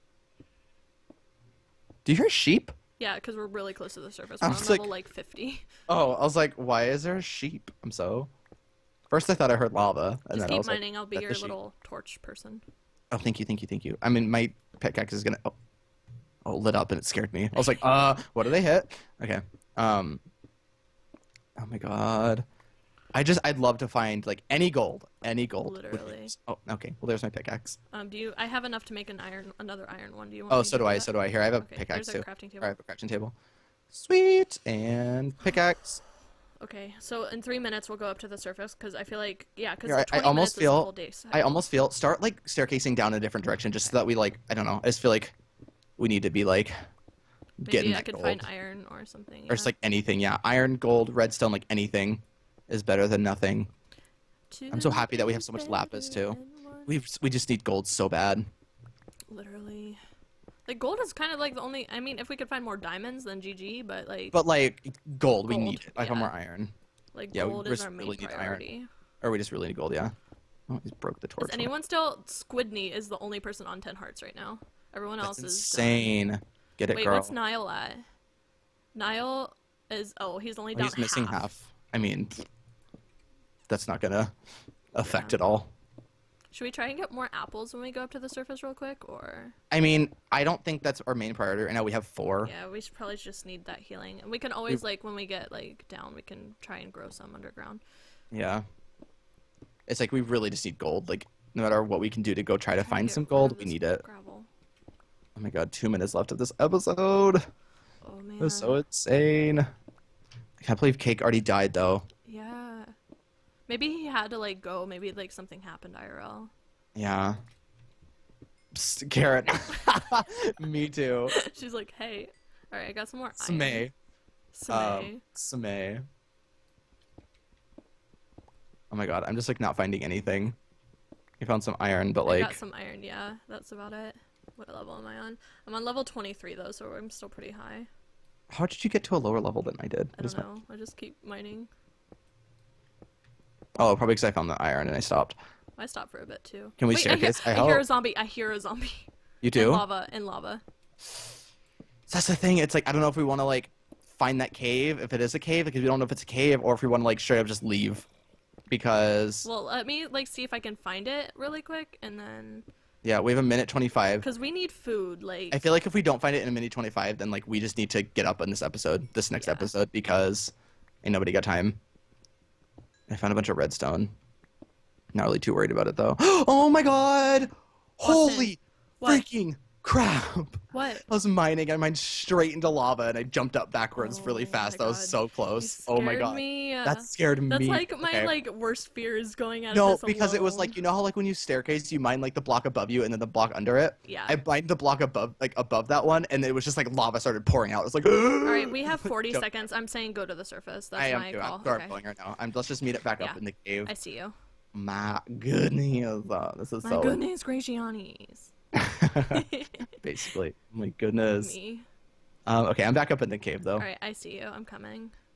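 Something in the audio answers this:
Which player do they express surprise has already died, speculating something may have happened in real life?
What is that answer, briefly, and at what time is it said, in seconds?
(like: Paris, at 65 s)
Cake, at 110 s.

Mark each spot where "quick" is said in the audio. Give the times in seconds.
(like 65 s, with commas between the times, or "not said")
88 s, 161 s.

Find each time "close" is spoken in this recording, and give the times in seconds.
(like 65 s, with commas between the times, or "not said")
3 s, 185 s.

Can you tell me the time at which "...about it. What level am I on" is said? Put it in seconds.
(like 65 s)
133 s.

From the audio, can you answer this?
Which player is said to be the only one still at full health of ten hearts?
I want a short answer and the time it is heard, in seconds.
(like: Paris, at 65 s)
Squidney, at 72 s.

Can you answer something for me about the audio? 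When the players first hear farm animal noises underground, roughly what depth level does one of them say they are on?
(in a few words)
50.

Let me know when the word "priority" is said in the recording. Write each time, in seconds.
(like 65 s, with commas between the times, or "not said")
68 s, 91 s.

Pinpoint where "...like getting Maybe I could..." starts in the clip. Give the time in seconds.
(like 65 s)
46 s.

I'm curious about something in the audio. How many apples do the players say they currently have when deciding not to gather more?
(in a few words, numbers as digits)
4.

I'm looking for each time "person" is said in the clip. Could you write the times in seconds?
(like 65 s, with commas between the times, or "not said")
12 s, 73 s.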